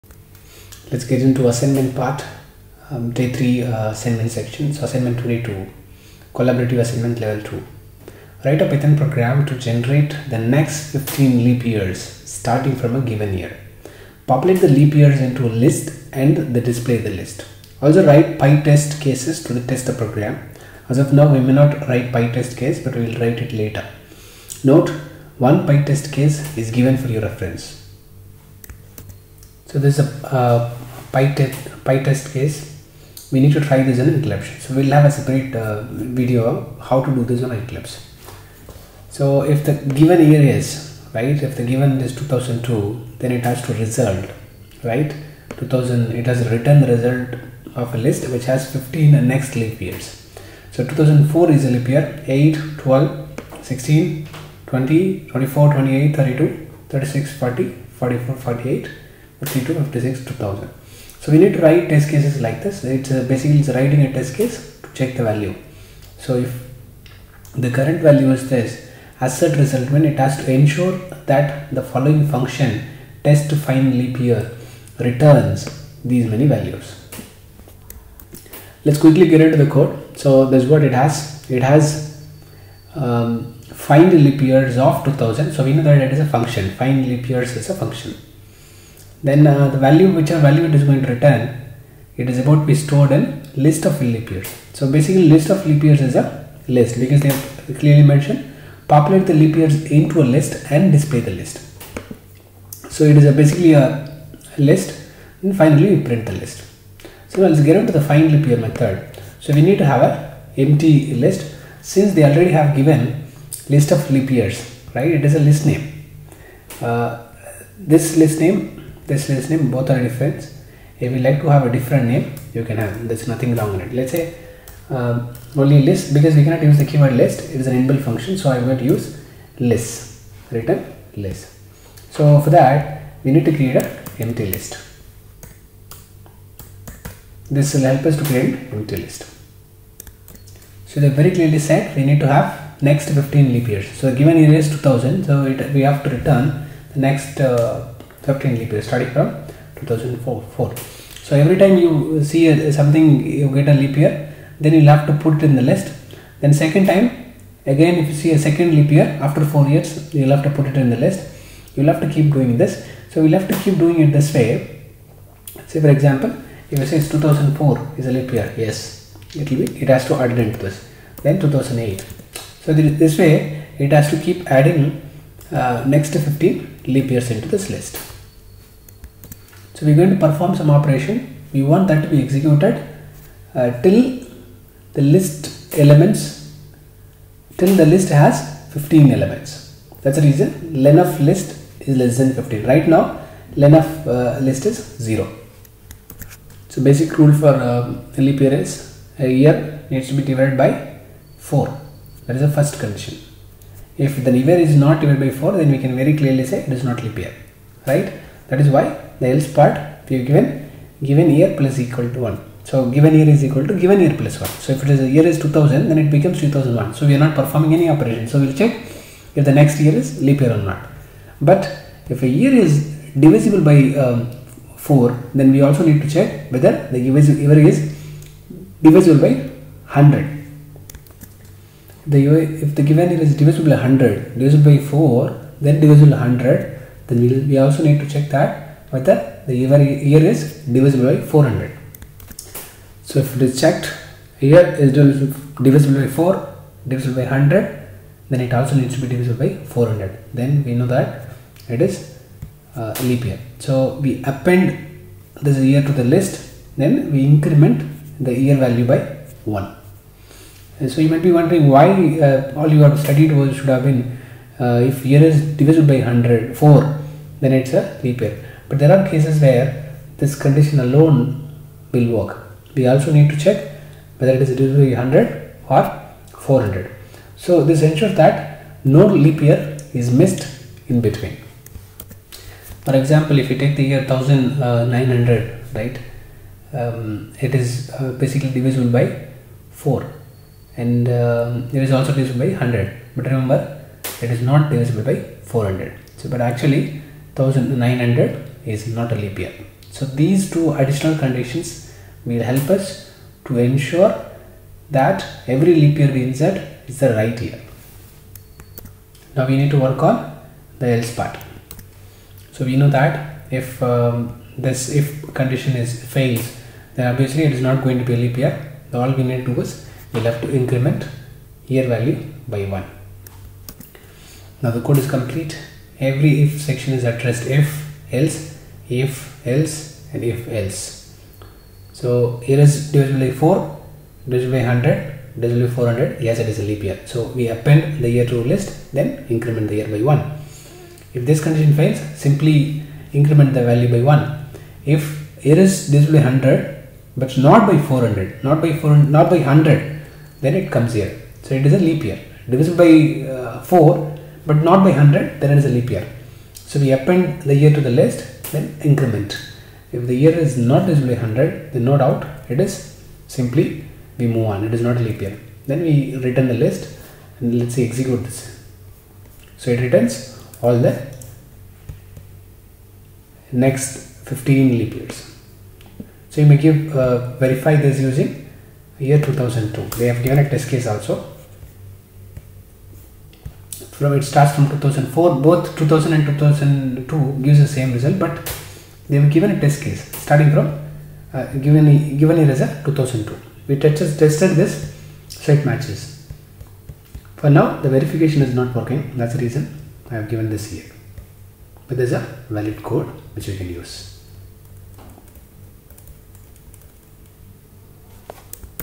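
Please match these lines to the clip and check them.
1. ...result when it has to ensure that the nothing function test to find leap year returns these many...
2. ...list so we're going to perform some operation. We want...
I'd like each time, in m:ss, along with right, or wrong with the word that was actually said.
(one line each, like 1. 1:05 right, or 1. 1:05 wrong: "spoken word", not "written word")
1. 1:09 wrong: "following", not "nothing"
2. 2:57 right.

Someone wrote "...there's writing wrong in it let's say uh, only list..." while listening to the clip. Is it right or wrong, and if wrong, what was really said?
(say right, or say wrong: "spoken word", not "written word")
wrong: "nothing", not "writing".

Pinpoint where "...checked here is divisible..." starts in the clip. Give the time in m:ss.
4:03.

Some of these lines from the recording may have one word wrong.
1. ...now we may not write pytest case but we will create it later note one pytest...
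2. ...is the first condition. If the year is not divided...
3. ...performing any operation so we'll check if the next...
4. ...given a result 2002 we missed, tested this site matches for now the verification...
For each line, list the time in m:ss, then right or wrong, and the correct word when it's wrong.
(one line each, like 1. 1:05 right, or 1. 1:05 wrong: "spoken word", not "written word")
1. 0:21 wrong: "write", not "create"
2. 3:22 right
3. 3:37 right
4. 6:32 wrong: "tested", not "missed".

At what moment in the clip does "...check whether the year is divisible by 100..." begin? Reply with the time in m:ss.
3:46.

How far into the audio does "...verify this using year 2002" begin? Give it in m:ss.
6:17.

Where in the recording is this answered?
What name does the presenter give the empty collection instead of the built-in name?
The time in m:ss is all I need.
2:10.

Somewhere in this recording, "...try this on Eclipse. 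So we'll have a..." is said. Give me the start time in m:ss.
0:33.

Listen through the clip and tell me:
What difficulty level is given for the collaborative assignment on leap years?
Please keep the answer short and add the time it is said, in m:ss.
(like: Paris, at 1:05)
Level 2, at 0:07.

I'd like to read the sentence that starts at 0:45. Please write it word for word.
2000, it has written the result of a list which has 15 next leap years.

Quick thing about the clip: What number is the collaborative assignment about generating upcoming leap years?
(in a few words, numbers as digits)
22.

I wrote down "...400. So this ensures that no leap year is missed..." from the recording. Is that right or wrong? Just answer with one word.
right.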